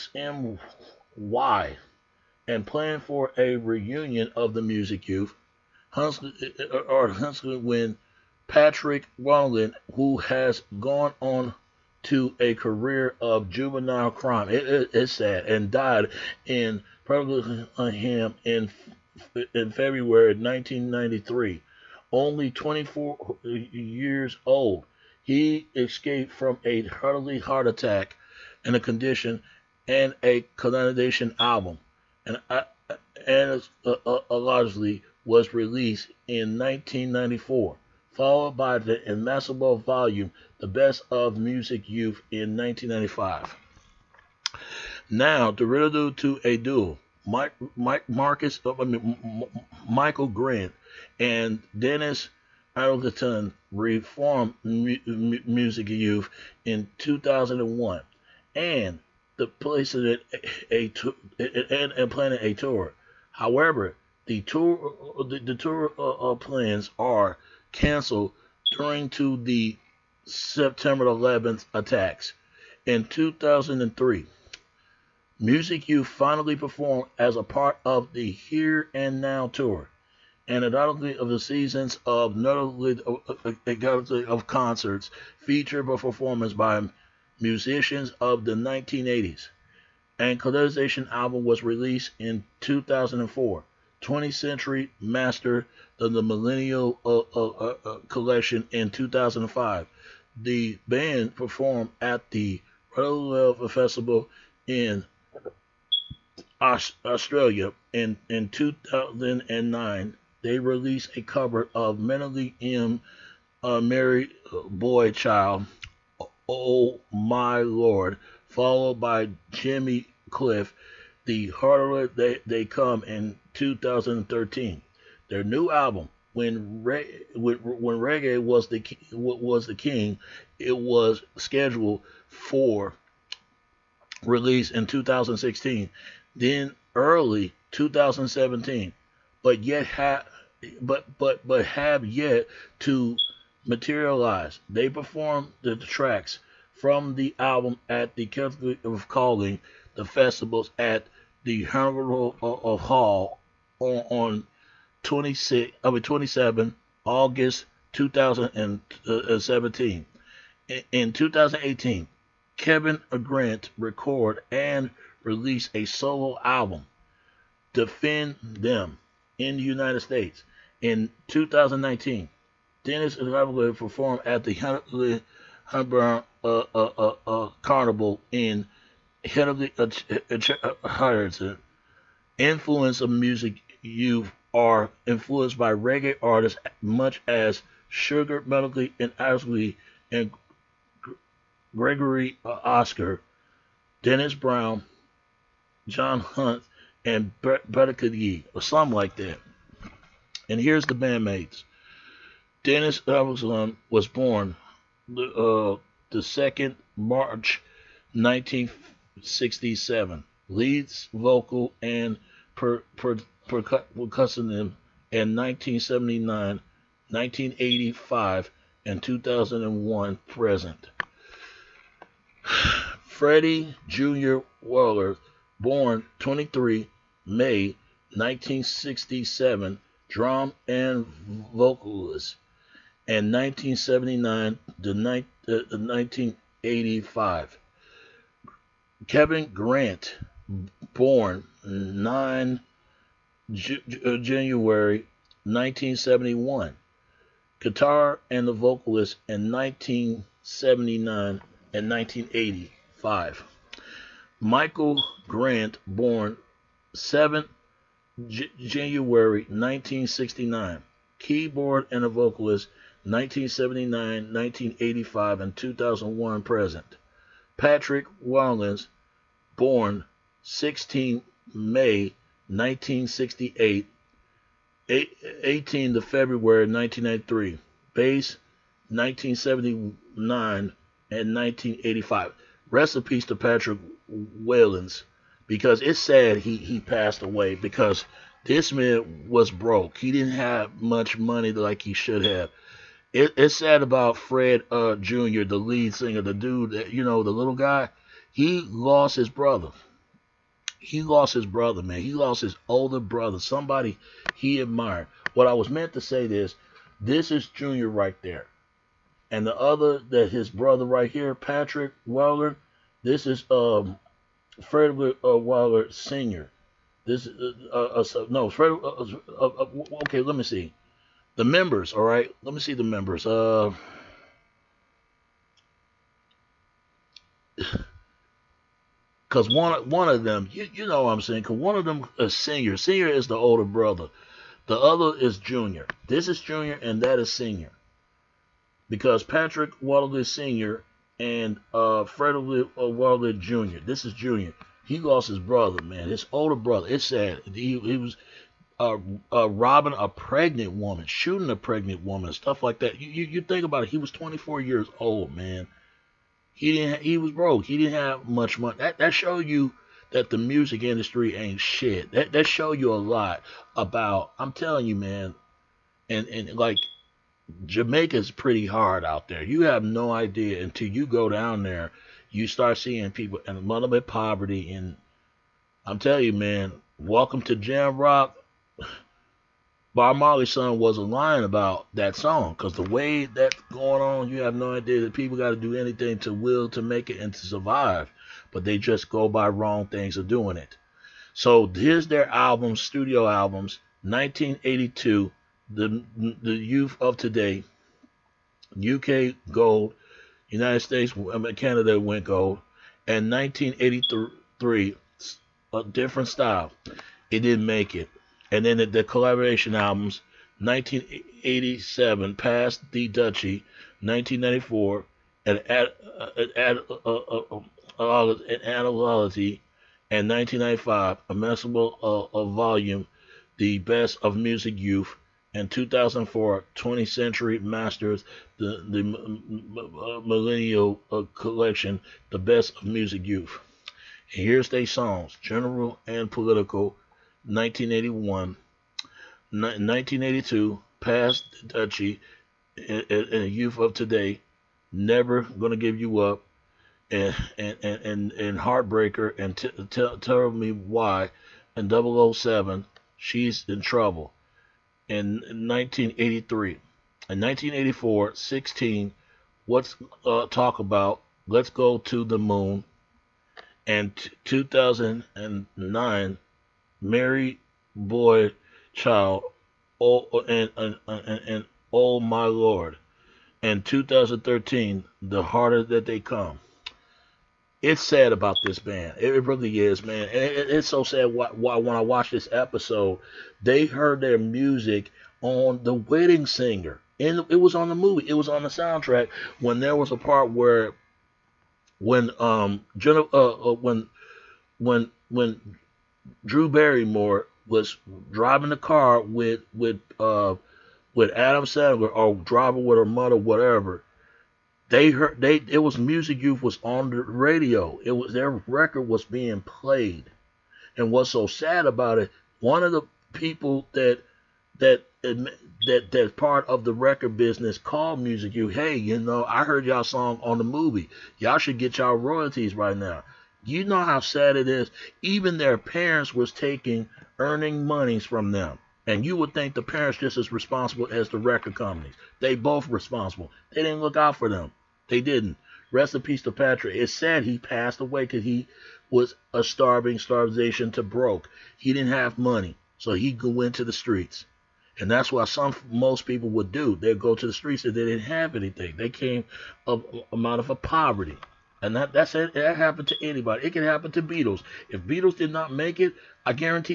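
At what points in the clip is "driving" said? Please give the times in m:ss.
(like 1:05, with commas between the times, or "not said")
8:18, 8:22.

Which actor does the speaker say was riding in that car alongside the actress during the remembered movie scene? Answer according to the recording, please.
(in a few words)
Adam Sandler.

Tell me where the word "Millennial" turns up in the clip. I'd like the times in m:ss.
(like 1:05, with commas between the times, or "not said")
1:36, 7:10.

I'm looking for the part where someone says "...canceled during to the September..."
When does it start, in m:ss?
1:07.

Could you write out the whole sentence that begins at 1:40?
The band performed at the Royal Festival in Australia in, in 2009.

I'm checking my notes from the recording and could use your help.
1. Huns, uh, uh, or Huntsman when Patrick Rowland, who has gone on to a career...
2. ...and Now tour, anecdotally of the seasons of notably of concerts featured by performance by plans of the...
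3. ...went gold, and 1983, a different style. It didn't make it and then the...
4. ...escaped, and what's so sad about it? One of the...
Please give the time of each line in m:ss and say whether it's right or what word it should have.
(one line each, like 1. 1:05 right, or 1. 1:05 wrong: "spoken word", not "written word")
1. 0:05 right
2. 1:18 wrong: "musicians", not "plans"
3. 6:42 right
4. 8:29 wrong: "played", not "escaped".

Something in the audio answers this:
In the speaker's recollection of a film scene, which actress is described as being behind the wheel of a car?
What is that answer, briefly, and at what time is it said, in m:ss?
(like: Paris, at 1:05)
Drew Barrymore, at 8:16.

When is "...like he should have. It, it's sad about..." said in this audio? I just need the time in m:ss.
4:51.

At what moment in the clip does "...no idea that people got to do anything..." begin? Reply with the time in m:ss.
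6:24.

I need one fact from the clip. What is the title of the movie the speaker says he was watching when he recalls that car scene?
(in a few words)
The Wedding Singer.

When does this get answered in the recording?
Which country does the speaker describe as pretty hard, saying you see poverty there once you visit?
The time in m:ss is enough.
6:07.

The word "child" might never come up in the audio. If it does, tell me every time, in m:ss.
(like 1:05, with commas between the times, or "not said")
1:55, 7:48.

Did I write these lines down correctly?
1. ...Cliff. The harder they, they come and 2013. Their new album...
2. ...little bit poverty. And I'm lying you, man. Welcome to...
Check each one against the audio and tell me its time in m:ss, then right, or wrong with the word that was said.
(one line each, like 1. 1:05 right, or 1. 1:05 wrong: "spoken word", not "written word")
1. 2:00 right
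2. 6:13 wrong: "telling", not "lying".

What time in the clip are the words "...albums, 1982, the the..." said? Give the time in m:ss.
6:33.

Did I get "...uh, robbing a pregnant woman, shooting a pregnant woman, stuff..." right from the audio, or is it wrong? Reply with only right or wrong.
right.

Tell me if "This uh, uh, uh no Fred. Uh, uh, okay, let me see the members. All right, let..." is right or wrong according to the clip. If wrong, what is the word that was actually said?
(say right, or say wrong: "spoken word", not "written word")
right.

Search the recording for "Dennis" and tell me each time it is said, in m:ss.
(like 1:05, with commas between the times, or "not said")
0:51, 2:52, 3:14, 3:22.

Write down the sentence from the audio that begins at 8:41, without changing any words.
Y'all should get y'all royalties right now.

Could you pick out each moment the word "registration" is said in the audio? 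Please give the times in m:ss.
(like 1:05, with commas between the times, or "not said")
not said.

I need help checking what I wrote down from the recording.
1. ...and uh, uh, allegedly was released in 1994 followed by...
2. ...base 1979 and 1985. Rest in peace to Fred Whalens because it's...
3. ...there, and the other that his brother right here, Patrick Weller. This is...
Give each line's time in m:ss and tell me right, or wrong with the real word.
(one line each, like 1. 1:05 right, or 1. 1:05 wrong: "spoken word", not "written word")
1. 0:33 right
2. 4:37 wrong: "Patrick", not "Fred"
3. 5:08 right.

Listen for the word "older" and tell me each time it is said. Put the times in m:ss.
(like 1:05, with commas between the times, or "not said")
5:02, 5:33, 5:46.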